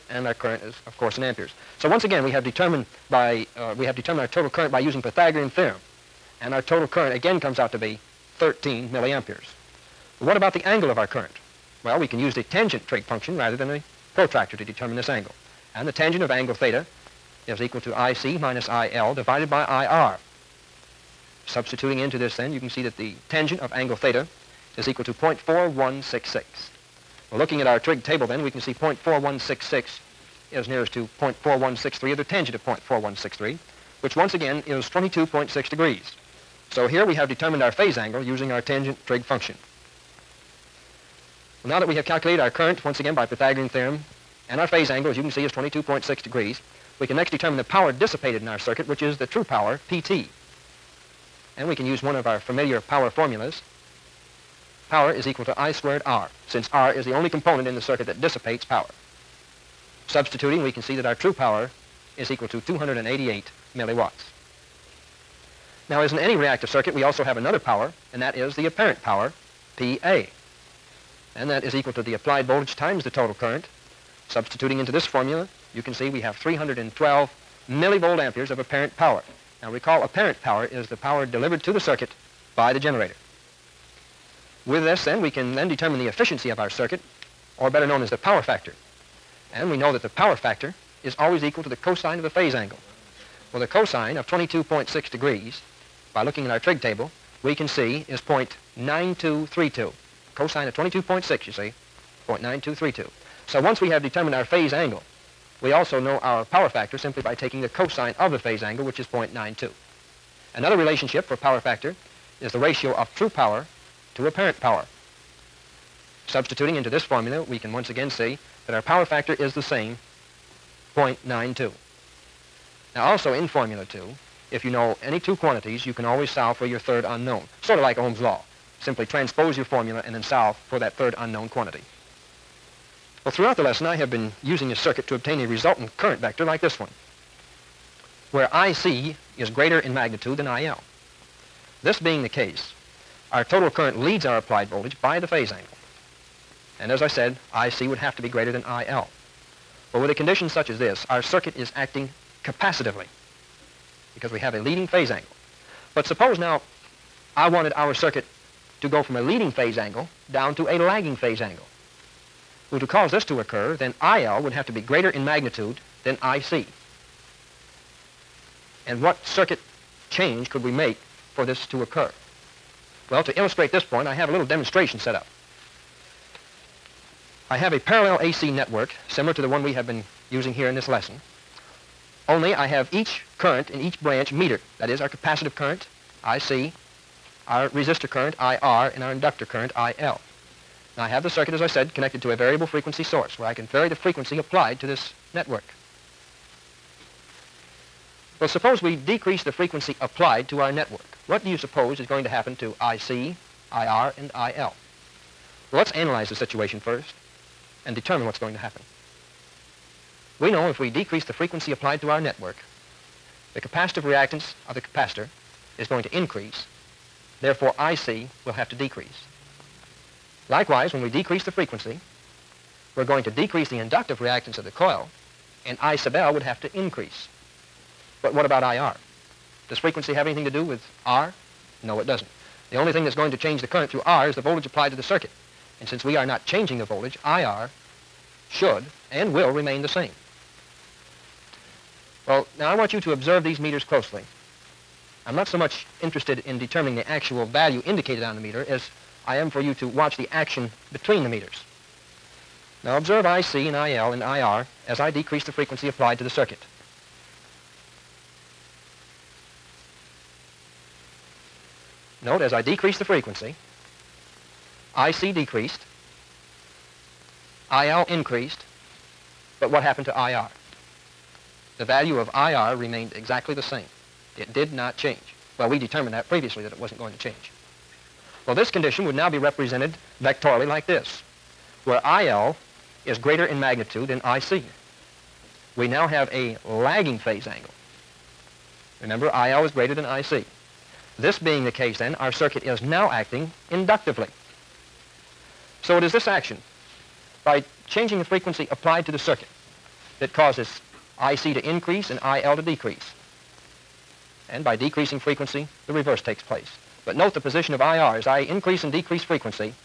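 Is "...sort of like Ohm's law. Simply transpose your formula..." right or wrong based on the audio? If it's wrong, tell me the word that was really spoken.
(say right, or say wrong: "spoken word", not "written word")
right.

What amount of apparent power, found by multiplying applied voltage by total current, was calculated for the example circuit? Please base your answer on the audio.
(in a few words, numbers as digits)
312 millivolt amperes.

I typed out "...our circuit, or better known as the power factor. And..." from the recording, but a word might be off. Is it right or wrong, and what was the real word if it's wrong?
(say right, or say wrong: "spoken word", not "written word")
right.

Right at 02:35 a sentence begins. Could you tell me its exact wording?
But suppose now I wanted our circuit to go from a leading phase angle down to a lagging phase angle.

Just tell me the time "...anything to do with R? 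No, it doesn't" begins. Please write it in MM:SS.
03:50.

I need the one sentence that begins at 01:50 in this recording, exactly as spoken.
Another relationship for power factor is the ratio of true power to apparent power.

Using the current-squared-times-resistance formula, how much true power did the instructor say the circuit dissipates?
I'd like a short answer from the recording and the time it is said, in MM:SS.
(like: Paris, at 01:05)
288 milliwatts, at 01:02.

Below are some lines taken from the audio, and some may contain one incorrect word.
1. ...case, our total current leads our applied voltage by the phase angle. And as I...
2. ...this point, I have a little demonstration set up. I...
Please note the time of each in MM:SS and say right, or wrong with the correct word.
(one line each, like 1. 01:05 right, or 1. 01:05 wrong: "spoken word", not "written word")
1. 02:22 right
2. 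02:53 right.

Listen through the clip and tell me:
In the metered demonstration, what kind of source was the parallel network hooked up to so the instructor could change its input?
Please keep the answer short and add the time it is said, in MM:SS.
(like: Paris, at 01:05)
variable frequency source, at 03:12.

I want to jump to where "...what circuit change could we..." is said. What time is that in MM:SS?
02:49.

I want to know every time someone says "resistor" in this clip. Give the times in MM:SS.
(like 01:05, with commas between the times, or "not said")
03:07.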